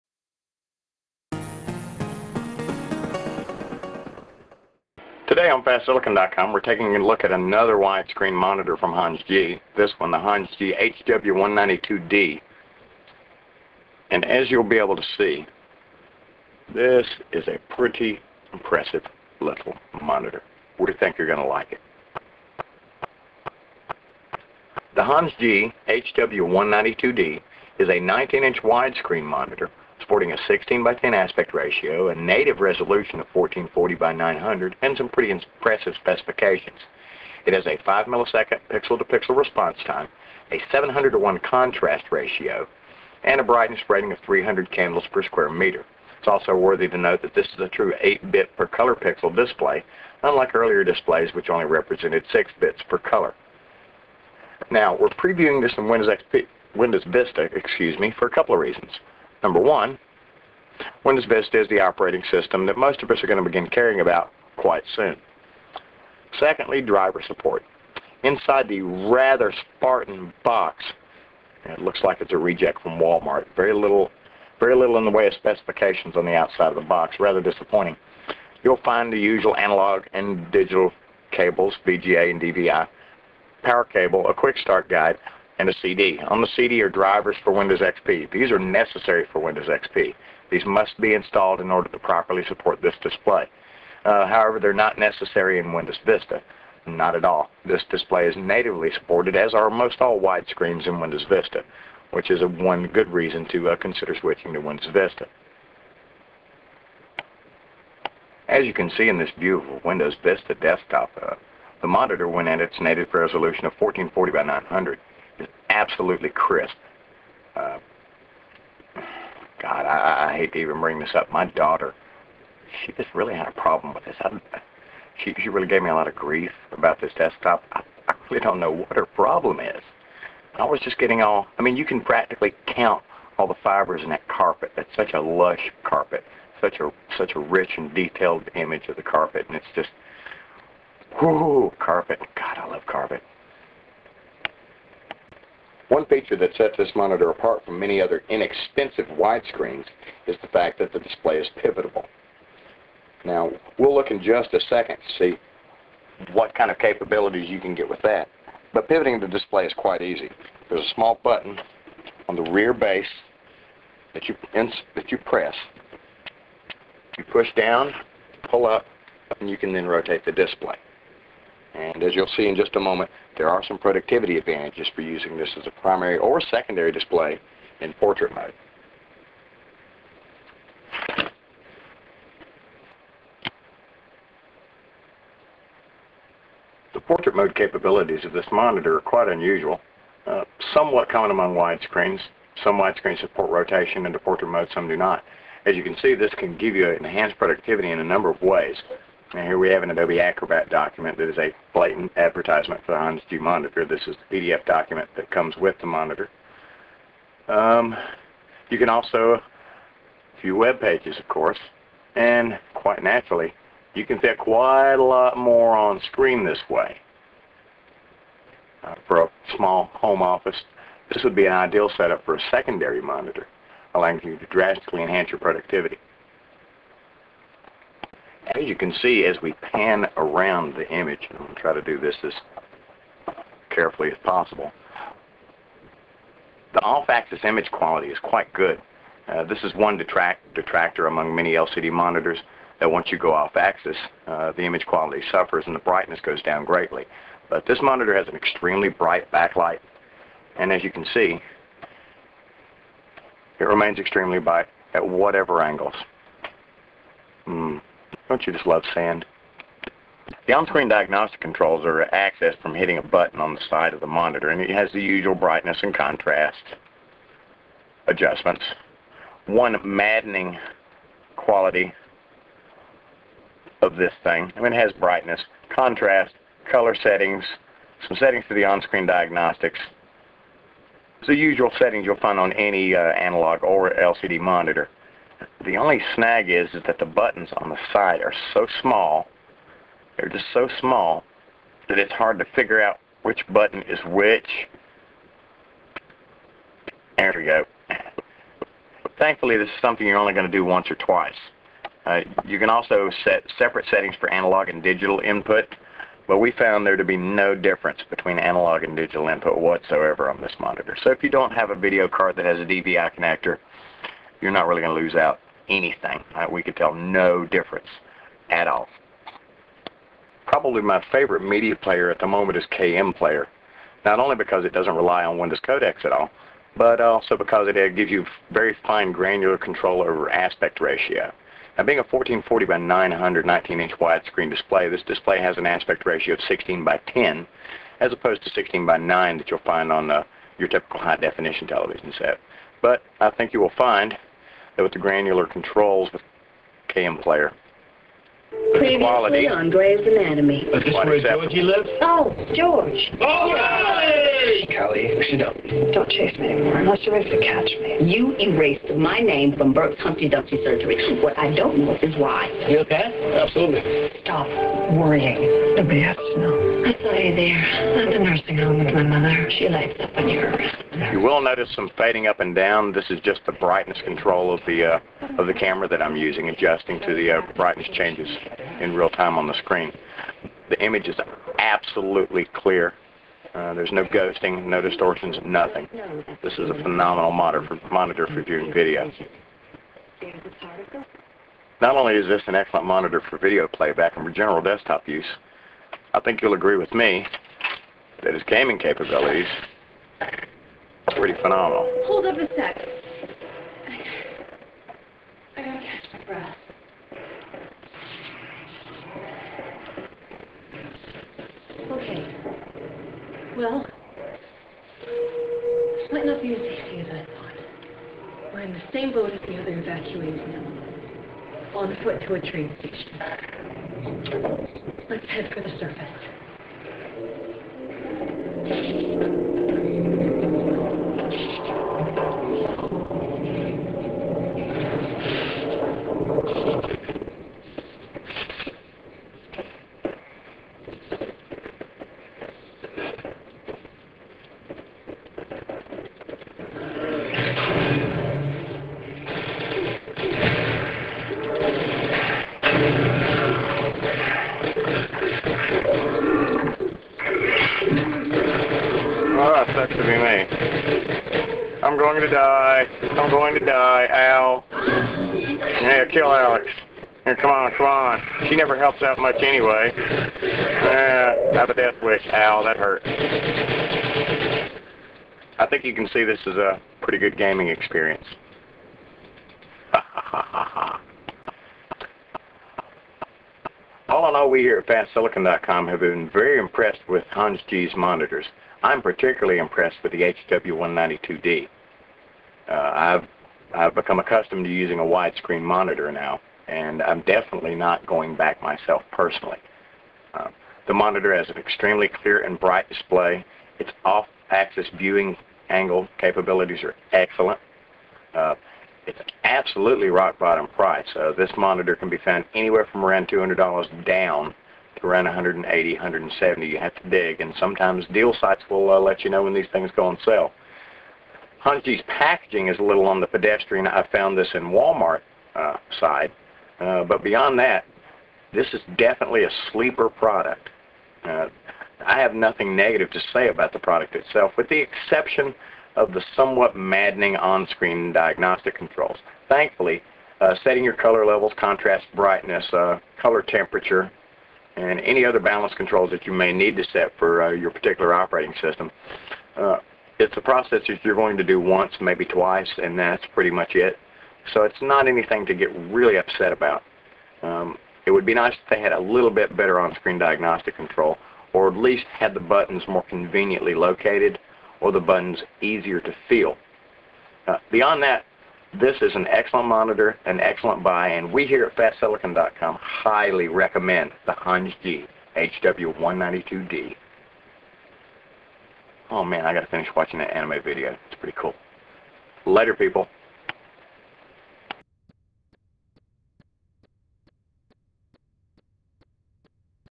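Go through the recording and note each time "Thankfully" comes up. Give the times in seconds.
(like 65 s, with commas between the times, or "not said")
299 s, 539 s.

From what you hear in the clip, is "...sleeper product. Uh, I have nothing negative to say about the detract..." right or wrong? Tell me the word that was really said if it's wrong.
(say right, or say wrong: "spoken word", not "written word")
wrong: "product", not "detract".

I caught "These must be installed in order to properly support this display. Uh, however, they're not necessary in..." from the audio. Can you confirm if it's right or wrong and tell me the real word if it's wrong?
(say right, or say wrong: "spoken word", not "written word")
right.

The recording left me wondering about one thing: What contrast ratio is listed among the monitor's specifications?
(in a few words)
700 to 1.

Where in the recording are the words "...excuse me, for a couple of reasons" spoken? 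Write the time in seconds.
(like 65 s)
57 s.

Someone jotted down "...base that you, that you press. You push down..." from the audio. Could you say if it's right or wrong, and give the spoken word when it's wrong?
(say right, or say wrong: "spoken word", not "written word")
right.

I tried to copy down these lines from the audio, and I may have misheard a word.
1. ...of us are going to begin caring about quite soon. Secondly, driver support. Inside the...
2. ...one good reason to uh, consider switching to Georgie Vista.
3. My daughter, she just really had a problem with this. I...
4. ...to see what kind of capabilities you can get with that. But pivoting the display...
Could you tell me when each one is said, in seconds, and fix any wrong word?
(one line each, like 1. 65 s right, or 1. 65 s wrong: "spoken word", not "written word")
1. 63 s right
2. 102 s wrong: "Windows", not "Georgie"
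3. 121 s right
4. 155 s right.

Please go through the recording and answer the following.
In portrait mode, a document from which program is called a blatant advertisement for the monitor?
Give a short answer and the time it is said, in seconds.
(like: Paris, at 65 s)
Adobe Acrobat, at 199 s.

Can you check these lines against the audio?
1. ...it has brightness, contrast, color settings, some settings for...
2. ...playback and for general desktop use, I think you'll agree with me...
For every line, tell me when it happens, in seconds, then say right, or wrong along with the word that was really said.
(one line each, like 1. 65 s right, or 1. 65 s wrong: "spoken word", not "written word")
1. 274 s right
2. 393 s right.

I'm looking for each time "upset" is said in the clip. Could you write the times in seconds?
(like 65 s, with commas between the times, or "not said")
556 s.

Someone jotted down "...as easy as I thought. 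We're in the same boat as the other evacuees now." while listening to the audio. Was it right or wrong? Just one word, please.
right.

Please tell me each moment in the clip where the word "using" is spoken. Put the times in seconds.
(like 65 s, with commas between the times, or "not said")
175 s, 376 s, 494 s.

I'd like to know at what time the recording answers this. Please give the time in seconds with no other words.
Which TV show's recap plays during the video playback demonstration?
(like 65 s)
349 s.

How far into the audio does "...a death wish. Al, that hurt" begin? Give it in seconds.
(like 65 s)
471 s.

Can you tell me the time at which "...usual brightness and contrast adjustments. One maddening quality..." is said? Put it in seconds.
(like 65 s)
265 s.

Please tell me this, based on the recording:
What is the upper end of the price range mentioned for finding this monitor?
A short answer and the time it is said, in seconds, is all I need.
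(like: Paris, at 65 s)
$200, at 513 s.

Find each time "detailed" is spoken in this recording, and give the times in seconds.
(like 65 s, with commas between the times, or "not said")
137 s.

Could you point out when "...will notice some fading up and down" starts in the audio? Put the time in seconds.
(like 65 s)
371 s.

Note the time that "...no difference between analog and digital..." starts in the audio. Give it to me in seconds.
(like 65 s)
307 s.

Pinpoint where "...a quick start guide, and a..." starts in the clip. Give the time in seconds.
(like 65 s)
84 s.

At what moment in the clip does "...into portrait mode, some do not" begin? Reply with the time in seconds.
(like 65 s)
194 s.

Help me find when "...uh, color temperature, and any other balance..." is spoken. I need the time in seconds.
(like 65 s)
542 s.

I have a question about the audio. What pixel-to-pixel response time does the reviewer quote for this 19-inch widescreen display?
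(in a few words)
5 milliseconds.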